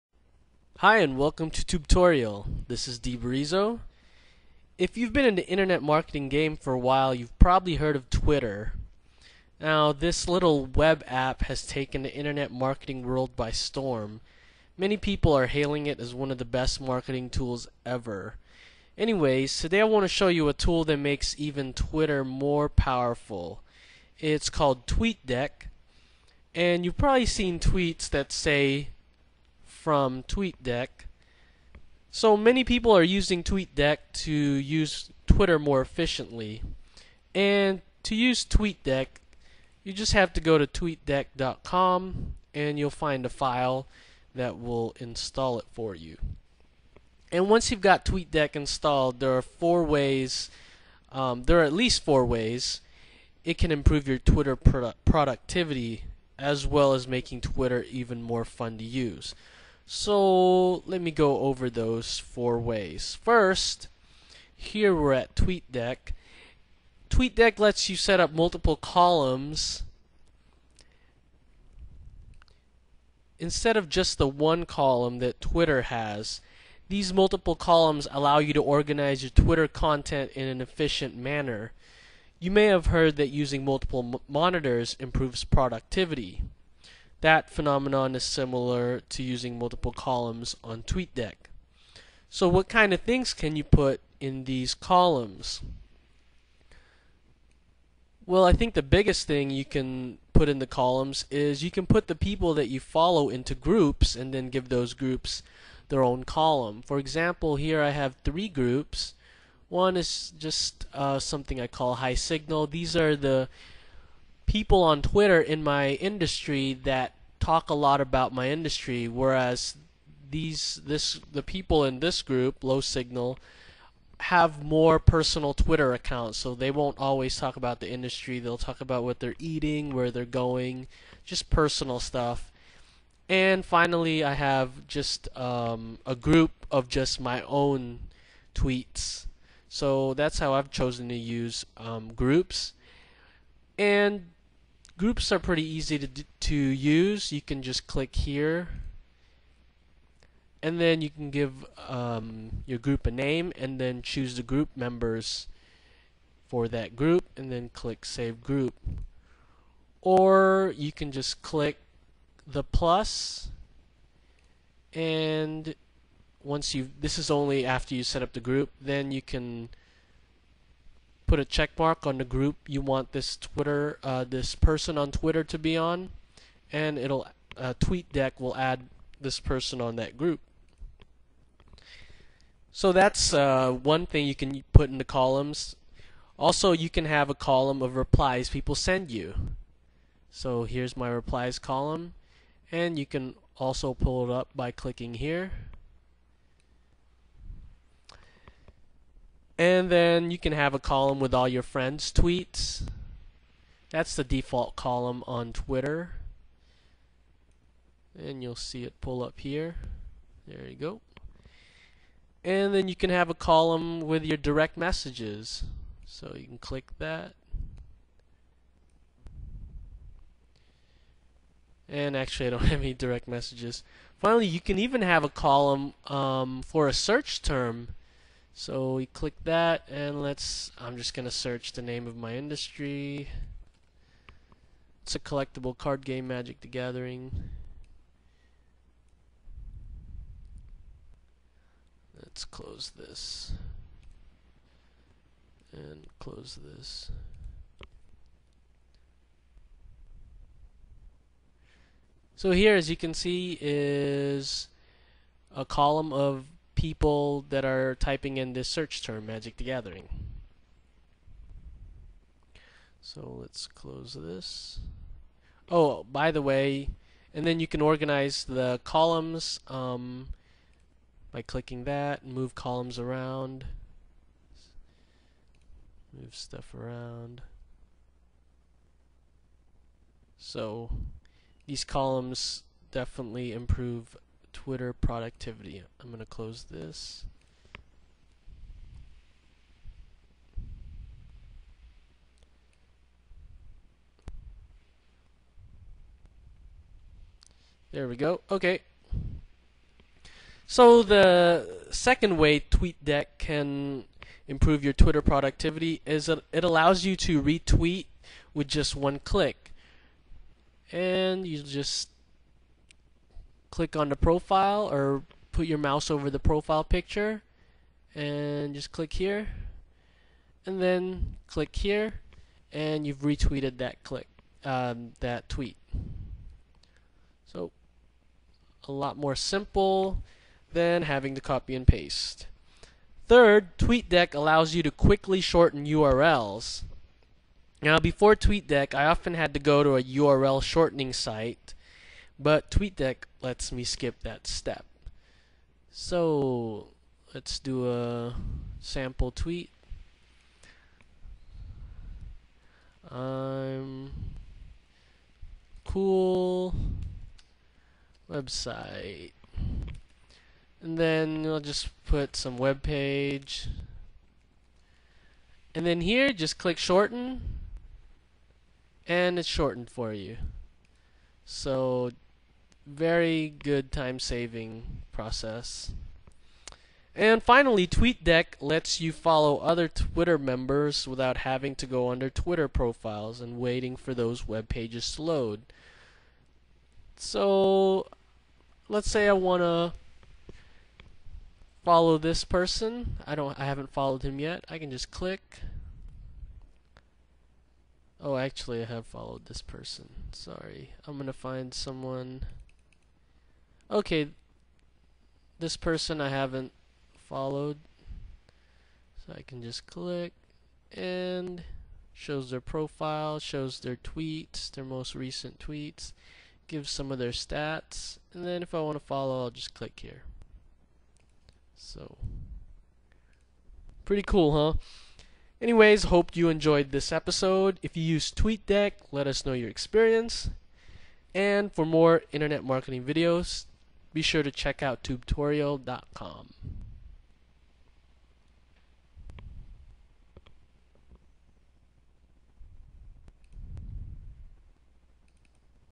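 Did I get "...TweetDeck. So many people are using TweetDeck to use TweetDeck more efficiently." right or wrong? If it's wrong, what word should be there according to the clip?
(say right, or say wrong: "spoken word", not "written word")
wrong: "Twitter", not "TweetDeck".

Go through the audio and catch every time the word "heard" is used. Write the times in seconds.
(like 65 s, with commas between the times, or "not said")
7 s, 82 s.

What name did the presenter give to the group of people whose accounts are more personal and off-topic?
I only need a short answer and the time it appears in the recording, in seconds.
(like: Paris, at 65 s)
Low Signal, at 122 s.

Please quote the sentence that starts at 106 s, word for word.
For example, here I have three groups.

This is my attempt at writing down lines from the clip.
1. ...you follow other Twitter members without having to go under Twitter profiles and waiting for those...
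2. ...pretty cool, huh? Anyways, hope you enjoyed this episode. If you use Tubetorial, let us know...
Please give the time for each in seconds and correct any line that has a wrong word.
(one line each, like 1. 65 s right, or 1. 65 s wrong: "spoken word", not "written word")
1. 379 s right
2. 424 s wrong: "TweetDeck", not "Tubetorial".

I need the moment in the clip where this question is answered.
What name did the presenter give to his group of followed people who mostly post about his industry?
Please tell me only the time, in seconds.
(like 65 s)
111 s.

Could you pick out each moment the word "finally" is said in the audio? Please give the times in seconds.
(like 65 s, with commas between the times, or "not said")
133 s, 224 s, 377 s.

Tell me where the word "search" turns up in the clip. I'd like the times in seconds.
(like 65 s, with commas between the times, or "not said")
226 s, 231 s, 258 s.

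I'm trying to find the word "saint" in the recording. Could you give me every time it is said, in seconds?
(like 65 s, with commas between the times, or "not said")
not said.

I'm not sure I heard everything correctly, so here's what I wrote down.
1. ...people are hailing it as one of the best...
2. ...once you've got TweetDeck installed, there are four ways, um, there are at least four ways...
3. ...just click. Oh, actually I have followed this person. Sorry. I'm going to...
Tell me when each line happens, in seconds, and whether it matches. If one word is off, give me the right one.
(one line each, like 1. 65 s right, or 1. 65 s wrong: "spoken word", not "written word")
1. 14 s right
2. 47 s right
3. 394 s right.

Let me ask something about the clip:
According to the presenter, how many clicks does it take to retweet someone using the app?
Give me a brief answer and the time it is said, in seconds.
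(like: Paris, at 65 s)
1, at 308 s.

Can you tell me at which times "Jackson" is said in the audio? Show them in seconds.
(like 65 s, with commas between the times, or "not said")
not said.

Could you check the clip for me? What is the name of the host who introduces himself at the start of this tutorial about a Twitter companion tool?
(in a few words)
DeBrizo.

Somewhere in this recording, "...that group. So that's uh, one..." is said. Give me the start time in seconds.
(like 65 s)
179 s.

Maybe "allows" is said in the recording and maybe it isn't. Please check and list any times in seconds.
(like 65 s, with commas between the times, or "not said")
78 s, 306 s, 334 s.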